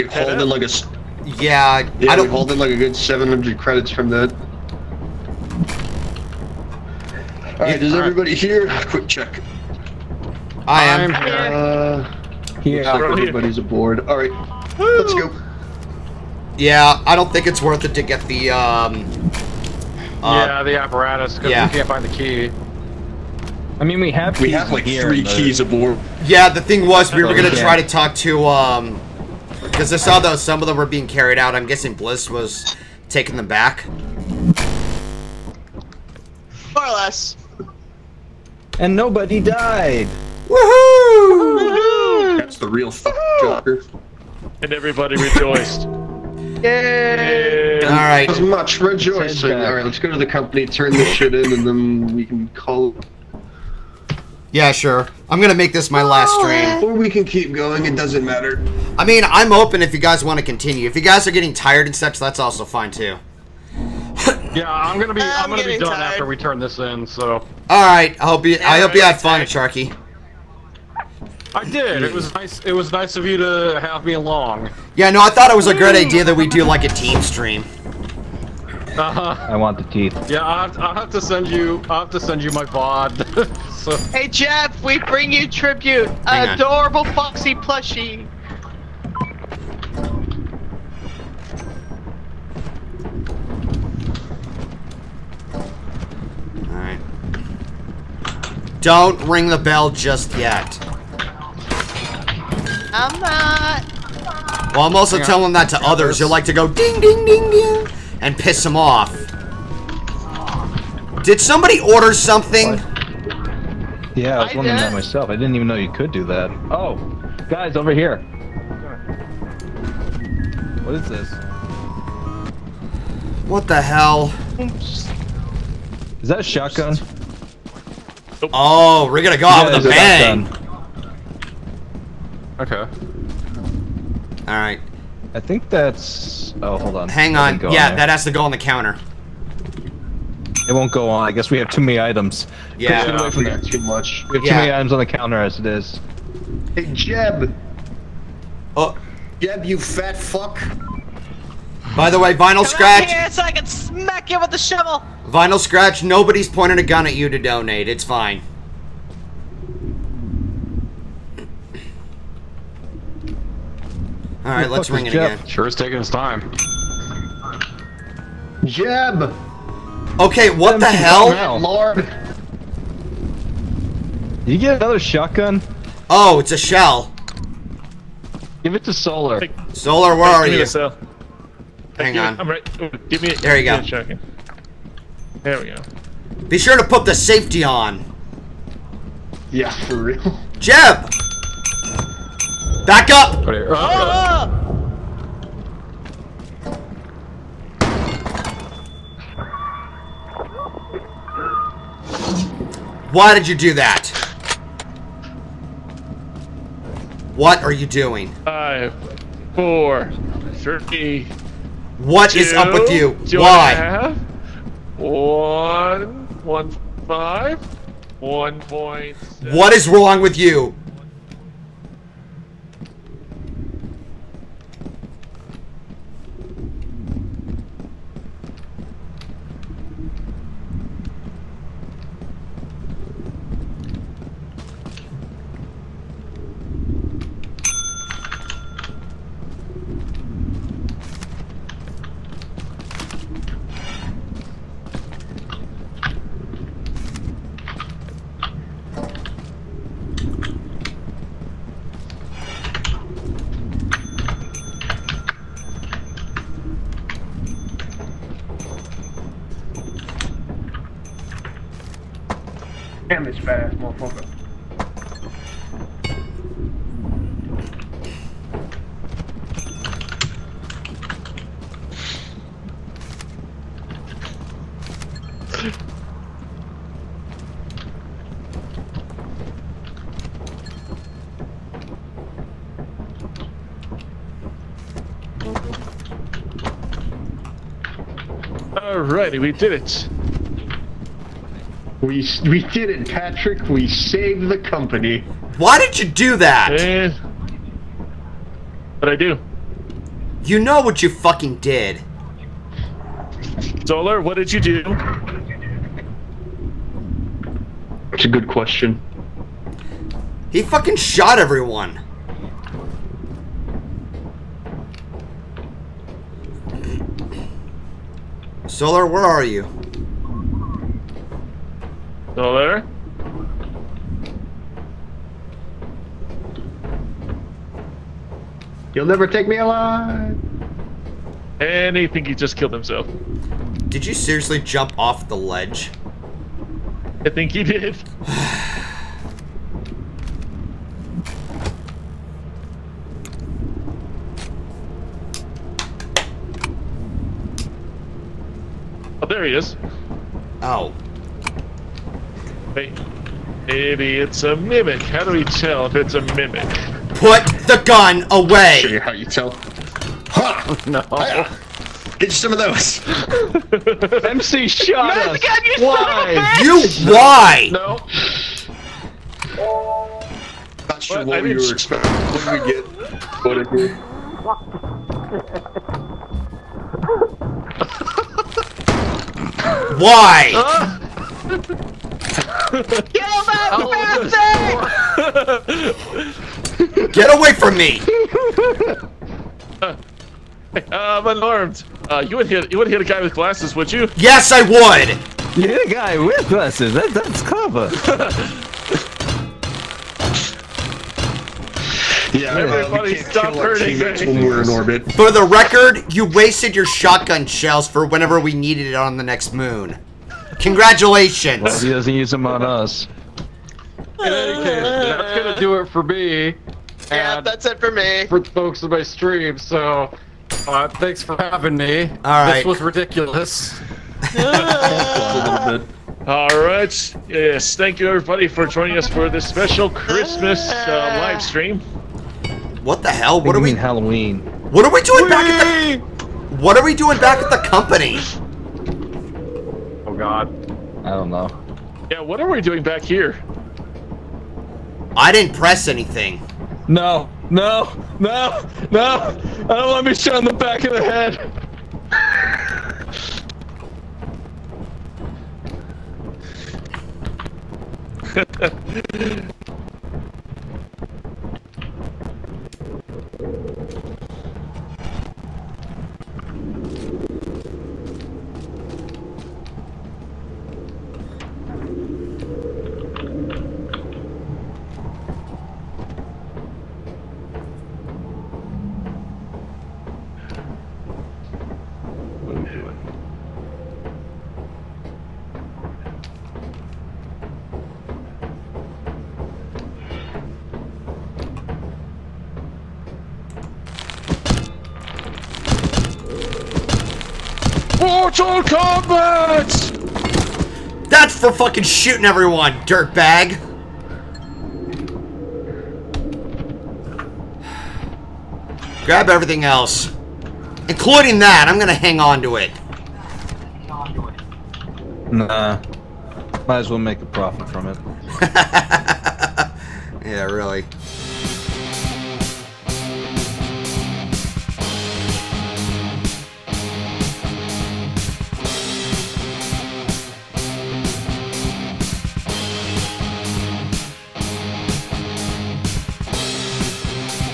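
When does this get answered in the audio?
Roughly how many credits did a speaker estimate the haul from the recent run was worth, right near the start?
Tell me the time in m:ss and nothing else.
0:02.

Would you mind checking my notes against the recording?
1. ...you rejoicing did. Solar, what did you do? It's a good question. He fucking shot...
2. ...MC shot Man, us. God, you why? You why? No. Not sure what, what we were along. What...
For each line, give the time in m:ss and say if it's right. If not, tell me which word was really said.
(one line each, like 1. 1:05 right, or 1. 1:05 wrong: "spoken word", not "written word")
1. 5:01 wrong: "fucking", not "rejoicing"
2. 6:04 wrong: "expecting", not "along".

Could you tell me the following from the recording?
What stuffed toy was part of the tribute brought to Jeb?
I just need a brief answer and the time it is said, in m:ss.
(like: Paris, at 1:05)
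Foxy plushie, at 1:27.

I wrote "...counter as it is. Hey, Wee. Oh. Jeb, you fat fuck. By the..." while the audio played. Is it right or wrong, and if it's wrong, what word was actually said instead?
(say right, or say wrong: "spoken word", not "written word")
wrong: "Jeb", not "Wee".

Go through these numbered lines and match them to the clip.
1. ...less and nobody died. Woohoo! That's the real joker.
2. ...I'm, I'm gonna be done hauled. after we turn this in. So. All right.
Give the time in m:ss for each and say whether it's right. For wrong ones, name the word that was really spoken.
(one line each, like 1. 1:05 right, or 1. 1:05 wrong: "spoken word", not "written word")
1. 0:36 right
2. 1:05 wrong: "tired", not "hauled".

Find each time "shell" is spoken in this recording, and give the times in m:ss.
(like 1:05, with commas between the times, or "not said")
2:56, 6:47.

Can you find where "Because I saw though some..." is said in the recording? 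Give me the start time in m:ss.
0:29.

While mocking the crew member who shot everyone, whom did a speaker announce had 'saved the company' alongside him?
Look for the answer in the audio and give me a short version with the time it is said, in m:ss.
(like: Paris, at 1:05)
Patrick, at 4:53.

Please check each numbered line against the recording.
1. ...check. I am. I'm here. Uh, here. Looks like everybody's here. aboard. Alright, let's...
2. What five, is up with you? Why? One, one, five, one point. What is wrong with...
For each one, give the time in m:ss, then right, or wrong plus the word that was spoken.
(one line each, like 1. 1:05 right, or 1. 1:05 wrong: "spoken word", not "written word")
1. 0:09 right
2. 3:31 wrong: "two", not "five".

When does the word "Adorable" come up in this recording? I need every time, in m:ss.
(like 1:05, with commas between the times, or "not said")
1:26.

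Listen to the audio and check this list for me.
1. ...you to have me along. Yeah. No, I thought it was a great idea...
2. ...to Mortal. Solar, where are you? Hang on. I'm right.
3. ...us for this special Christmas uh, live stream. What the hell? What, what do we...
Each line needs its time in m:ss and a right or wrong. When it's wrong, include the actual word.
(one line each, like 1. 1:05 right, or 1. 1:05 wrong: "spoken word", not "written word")
1. 1:13 right
2. 2:58 wrong: "Solar", not "Mortal"
3. 7:08 right.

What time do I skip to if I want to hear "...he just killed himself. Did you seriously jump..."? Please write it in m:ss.
5:32.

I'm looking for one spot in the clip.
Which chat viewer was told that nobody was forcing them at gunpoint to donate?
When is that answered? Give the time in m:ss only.
2:35.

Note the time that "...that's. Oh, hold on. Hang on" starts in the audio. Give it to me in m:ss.
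2:15.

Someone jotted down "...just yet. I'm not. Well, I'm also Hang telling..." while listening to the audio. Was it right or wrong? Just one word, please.
right.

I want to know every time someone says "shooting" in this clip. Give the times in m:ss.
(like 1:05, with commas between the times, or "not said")
8:21.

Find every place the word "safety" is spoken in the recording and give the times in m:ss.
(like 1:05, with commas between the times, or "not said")
3:07.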